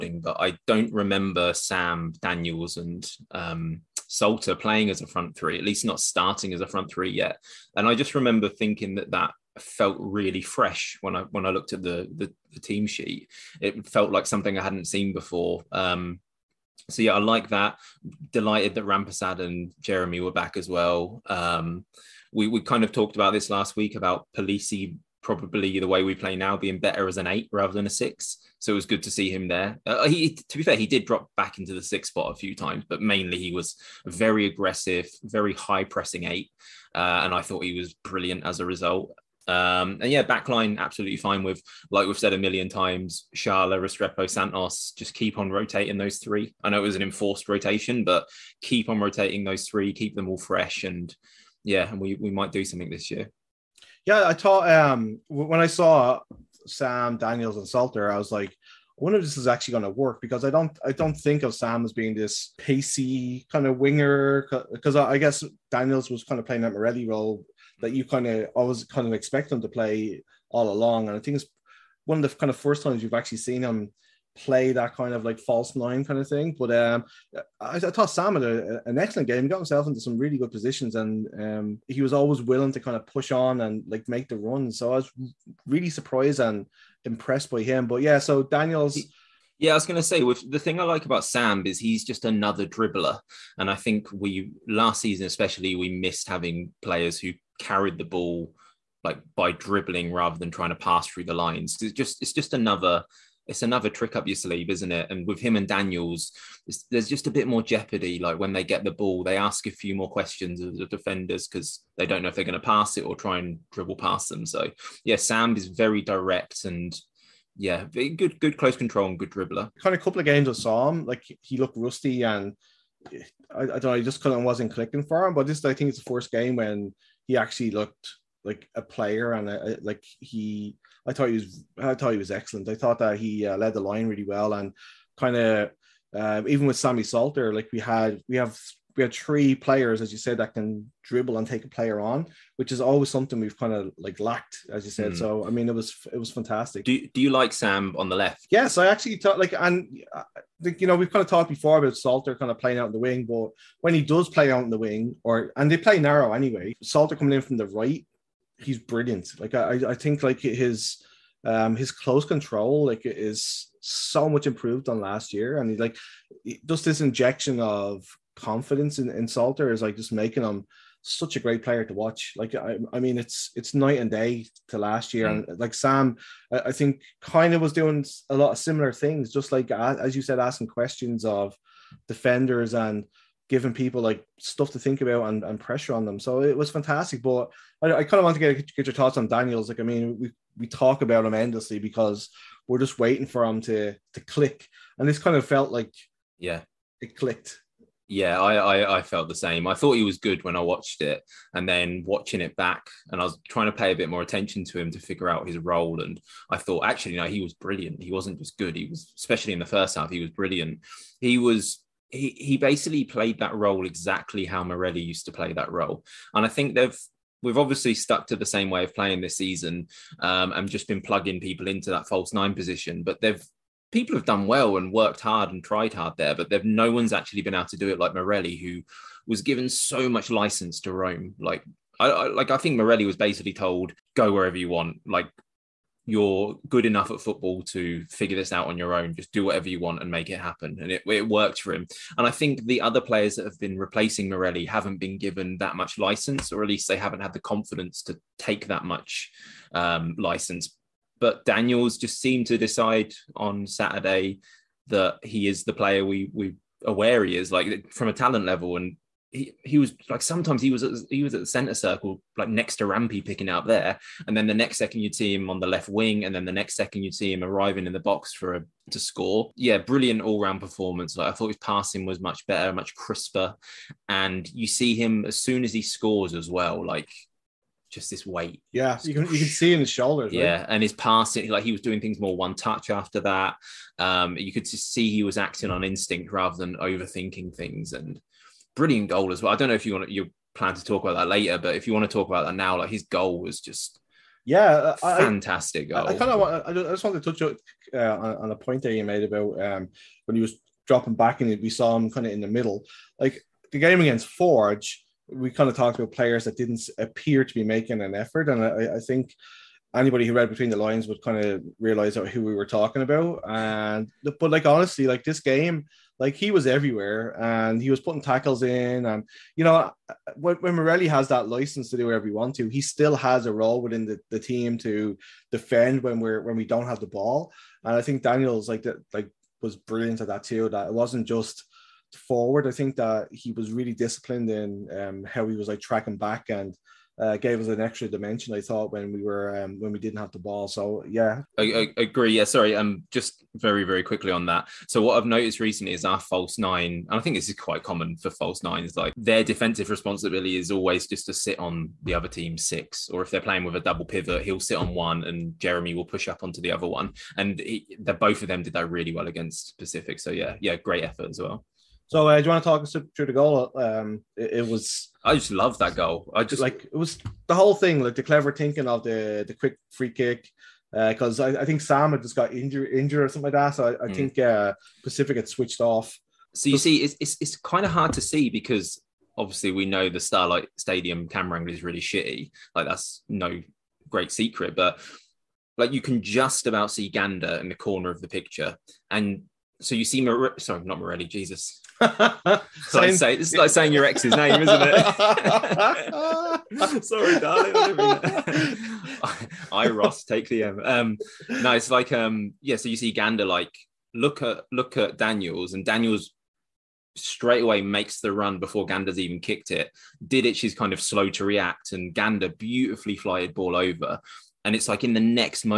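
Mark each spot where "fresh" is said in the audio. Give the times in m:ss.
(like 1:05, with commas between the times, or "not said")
0:10, 0:50.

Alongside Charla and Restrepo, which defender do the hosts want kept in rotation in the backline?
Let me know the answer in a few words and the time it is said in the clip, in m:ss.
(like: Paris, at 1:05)
Santos, at 0:44.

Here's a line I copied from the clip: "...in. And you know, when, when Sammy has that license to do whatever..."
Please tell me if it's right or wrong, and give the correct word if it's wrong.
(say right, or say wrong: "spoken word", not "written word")
wrong: "Morelli", not "Sammy".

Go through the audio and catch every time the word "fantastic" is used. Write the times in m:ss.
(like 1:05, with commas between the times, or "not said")
2:26, 3:06, 4:55.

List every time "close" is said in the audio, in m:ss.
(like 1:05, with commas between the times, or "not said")
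1:58, 2:41.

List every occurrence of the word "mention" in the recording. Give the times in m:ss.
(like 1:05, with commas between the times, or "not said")
not said.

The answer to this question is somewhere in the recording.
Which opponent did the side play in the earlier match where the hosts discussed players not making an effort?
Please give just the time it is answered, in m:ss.
5:04.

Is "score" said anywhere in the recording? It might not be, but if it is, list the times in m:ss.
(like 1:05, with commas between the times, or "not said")
4:28, 4:35.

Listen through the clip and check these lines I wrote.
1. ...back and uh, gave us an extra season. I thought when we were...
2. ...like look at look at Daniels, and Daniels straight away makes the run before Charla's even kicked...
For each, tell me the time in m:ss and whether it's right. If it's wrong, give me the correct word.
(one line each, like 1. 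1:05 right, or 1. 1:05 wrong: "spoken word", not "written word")
1. 5:36 wrong: "dimension", not "season"
2. 6:43 wrong: "Gander", not "Charla".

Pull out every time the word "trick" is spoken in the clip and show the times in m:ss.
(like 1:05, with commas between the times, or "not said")
1:43.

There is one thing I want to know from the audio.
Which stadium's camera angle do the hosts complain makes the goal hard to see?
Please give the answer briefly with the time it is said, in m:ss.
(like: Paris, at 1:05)
Starlight Stadium, at 6:20.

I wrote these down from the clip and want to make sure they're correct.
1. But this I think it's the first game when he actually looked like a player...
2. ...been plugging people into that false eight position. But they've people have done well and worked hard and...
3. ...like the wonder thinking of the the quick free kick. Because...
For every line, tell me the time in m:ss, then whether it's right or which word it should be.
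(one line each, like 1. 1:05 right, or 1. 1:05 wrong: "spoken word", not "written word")
1. 2:05 right
2. 3:40 wrong: "nine", not "eight"
3. 6:08 wrong: "clever", not "wonder".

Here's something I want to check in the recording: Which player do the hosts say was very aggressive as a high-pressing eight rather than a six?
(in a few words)
Polisi.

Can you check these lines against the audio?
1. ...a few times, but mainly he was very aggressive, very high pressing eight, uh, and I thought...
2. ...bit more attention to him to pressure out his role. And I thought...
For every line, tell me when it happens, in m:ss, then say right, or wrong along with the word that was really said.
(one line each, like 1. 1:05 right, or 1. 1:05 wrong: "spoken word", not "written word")
1. 0:32 right
2. 3:23 wrong: "figure", not "pressure".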